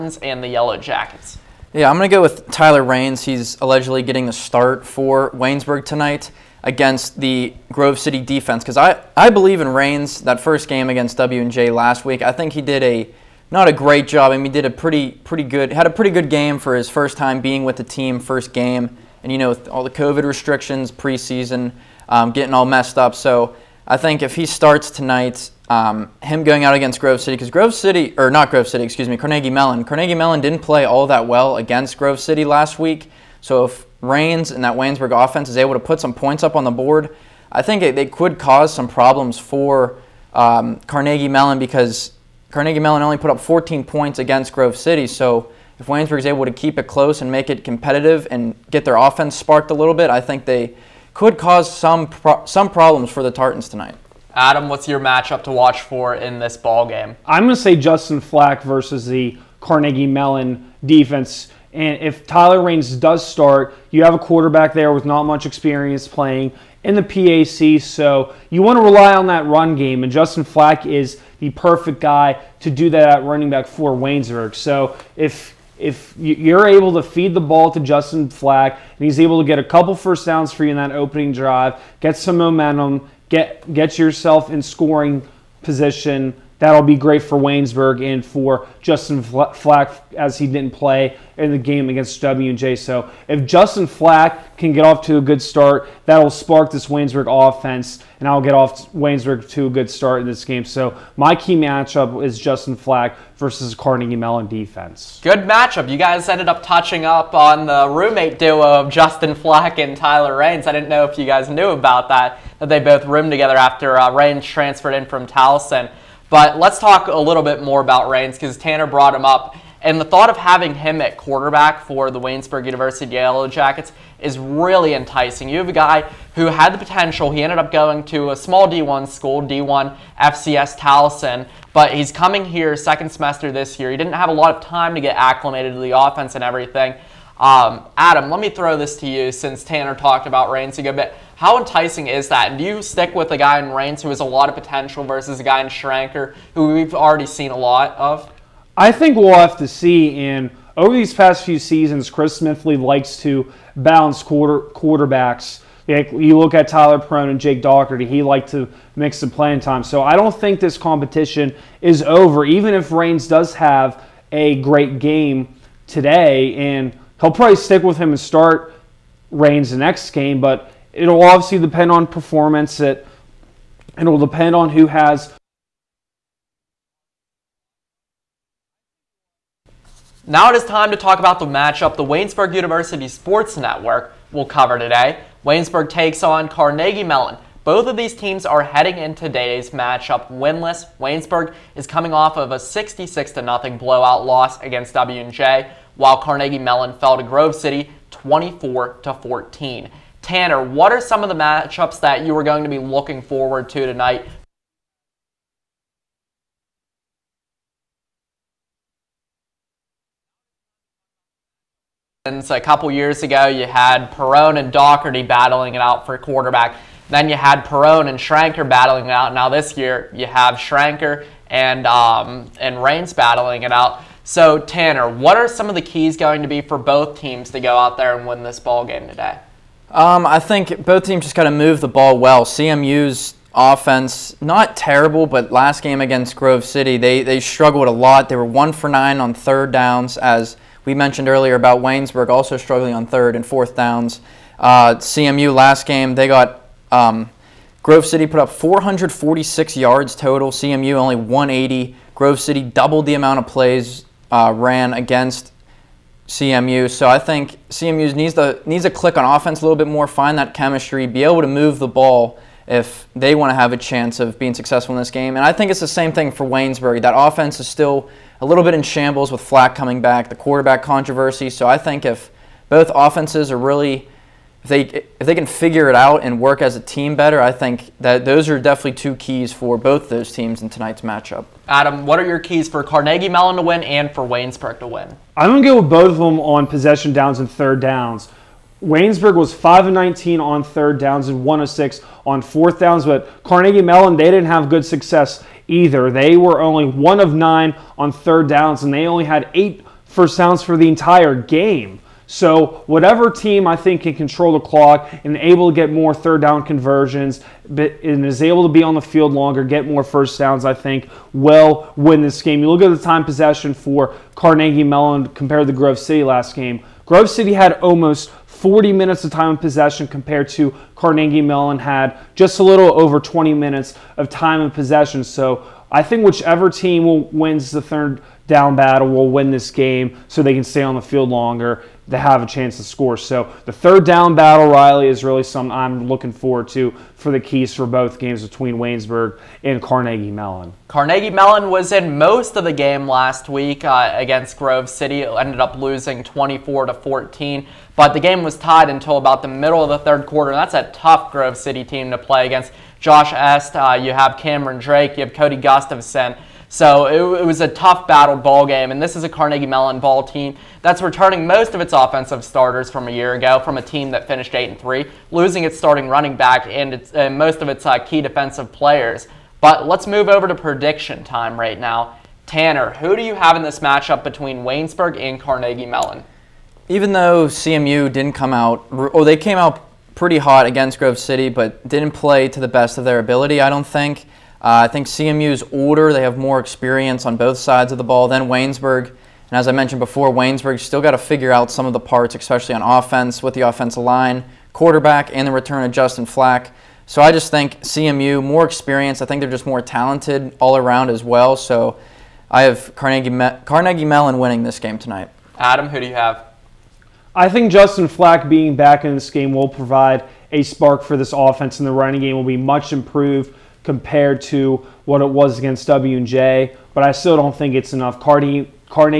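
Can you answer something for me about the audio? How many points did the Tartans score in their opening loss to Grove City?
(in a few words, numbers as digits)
14.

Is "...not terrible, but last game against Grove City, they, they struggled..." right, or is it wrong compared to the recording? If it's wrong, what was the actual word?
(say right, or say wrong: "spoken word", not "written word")
right.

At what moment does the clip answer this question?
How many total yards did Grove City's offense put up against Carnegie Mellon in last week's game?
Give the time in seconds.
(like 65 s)
248 s.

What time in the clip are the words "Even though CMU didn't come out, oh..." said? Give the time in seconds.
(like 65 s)
376 s.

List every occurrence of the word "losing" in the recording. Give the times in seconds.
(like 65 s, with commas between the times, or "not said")
345 s, 365 s.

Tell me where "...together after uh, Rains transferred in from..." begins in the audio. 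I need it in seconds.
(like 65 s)
113 s.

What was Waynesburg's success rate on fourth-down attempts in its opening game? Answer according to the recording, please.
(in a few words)
1 of 6.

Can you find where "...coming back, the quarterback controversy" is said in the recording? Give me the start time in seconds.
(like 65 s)
269 s.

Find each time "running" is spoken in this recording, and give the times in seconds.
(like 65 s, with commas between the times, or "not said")
73 s, 366 s, 411 s.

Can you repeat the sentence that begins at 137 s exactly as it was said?
Um, Adam, let me throw this to you since Tanner talked about Reigns a good bit.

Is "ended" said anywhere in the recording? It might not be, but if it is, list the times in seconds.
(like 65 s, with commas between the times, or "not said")
106 s, 127 s, 345 s.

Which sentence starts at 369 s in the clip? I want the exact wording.
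But let's move over to prediction time right now.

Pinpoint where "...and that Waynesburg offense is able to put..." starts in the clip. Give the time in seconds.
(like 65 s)
34 s.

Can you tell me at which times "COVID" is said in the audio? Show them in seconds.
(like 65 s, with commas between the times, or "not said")
19 s.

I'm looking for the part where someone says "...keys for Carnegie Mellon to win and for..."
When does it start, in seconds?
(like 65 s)
282 s.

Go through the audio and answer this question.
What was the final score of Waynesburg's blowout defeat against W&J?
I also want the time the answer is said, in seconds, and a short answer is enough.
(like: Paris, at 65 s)
66-0, at 192 s.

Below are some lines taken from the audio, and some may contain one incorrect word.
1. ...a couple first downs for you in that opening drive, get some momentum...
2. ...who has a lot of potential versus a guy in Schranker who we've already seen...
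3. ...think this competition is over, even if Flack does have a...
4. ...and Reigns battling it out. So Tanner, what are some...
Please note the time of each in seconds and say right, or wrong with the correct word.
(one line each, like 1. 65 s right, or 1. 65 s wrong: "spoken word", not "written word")
1. 79 s right
2. 144 s right
3. 160 s wrong: "Reigns", not "Flack"
4. 222 s right.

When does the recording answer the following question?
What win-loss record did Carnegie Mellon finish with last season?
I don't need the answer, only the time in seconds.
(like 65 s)
364 s.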